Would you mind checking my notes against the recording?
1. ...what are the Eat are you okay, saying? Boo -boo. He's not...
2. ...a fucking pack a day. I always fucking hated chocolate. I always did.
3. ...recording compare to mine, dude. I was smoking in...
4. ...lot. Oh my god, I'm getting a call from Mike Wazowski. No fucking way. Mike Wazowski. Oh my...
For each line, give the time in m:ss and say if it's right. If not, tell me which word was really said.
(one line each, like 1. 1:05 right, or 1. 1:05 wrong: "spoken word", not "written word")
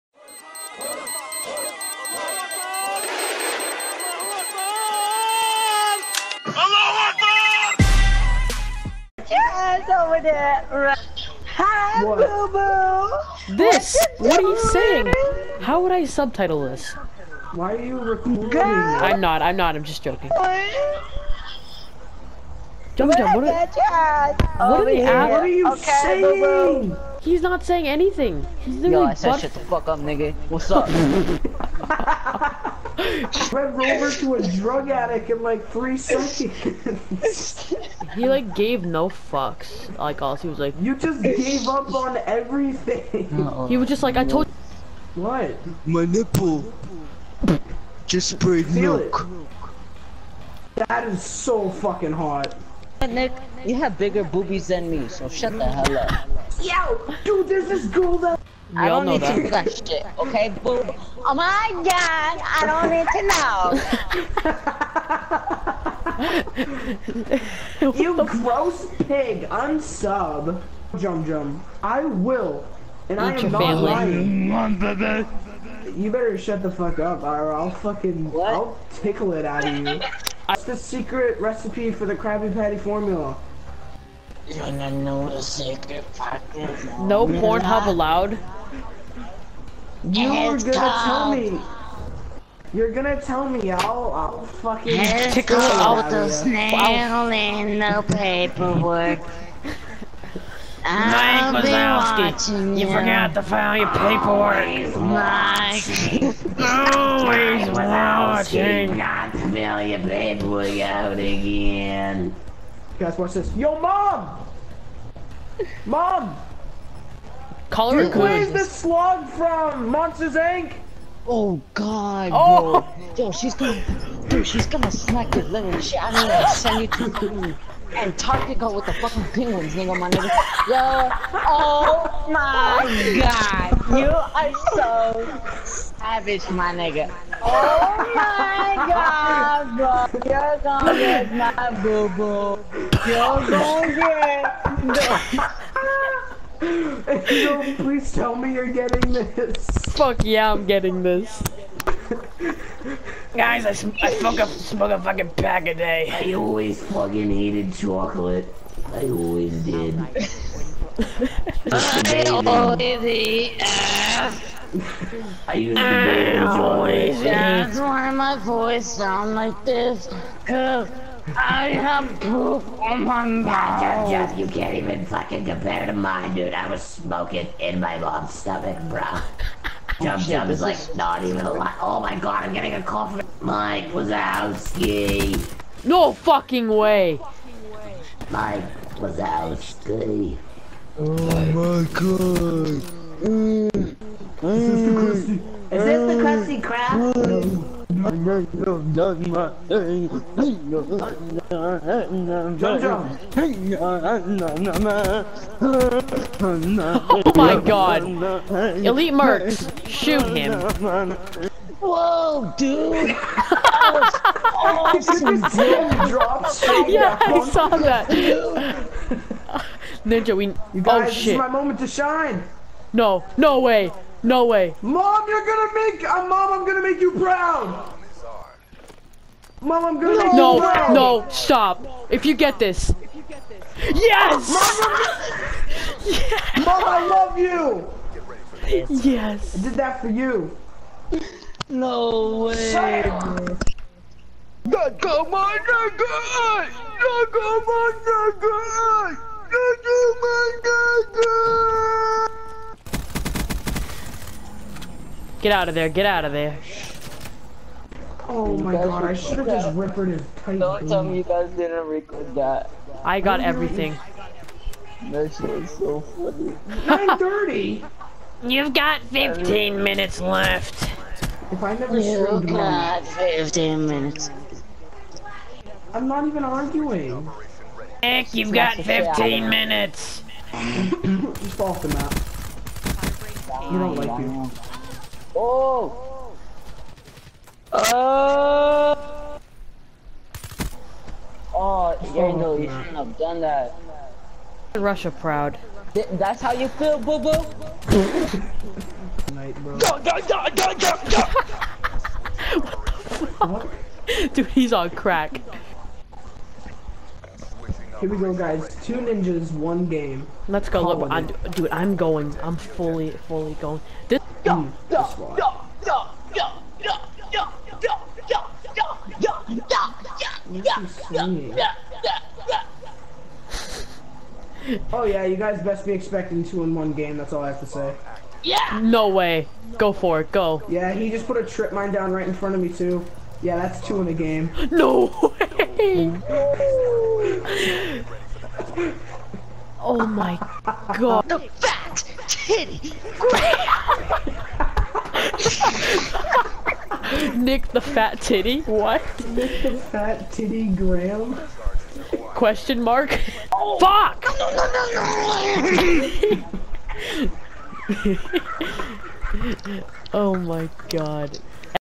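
1. 0:23 wrong: "What", not "Eat"
2. 2:34 right
3. 2:55 wrong: "fucking", not "recording"
4. 3:01 right.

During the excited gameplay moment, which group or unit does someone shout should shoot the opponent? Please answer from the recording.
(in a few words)
Elite Mercs.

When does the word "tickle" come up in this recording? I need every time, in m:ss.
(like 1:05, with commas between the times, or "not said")
1:18, 1:35.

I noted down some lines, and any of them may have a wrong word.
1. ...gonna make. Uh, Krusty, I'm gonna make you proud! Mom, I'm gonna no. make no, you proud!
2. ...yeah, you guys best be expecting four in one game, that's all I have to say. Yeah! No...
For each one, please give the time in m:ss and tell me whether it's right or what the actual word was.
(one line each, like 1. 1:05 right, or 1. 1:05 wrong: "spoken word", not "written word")
1. 3:45 wrong: "Mom", not "Krusty"
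2. 5:25 wrong: "two", not "four".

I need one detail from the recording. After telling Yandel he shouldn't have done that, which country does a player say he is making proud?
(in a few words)
Russia.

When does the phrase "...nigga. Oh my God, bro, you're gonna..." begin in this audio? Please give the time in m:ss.
2:16.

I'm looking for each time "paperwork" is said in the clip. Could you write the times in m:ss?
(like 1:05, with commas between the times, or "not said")
1:38, 1:43, 1:49.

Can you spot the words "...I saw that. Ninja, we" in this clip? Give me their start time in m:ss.
3:37.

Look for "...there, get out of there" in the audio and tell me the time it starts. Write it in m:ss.
4:15.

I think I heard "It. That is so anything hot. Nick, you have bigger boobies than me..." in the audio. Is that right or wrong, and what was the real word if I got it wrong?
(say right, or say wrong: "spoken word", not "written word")
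wrong: "fucking", not "anything".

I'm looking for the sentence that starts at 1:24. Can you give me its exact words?
You don't know the secret No Pornhub allowed?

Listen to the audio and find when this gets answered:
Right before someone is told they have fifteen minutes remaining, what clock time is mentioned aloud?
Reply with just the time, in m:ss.
4:26.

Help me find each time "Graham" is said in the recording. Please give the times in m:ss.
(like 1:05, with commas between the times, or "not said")
5:50.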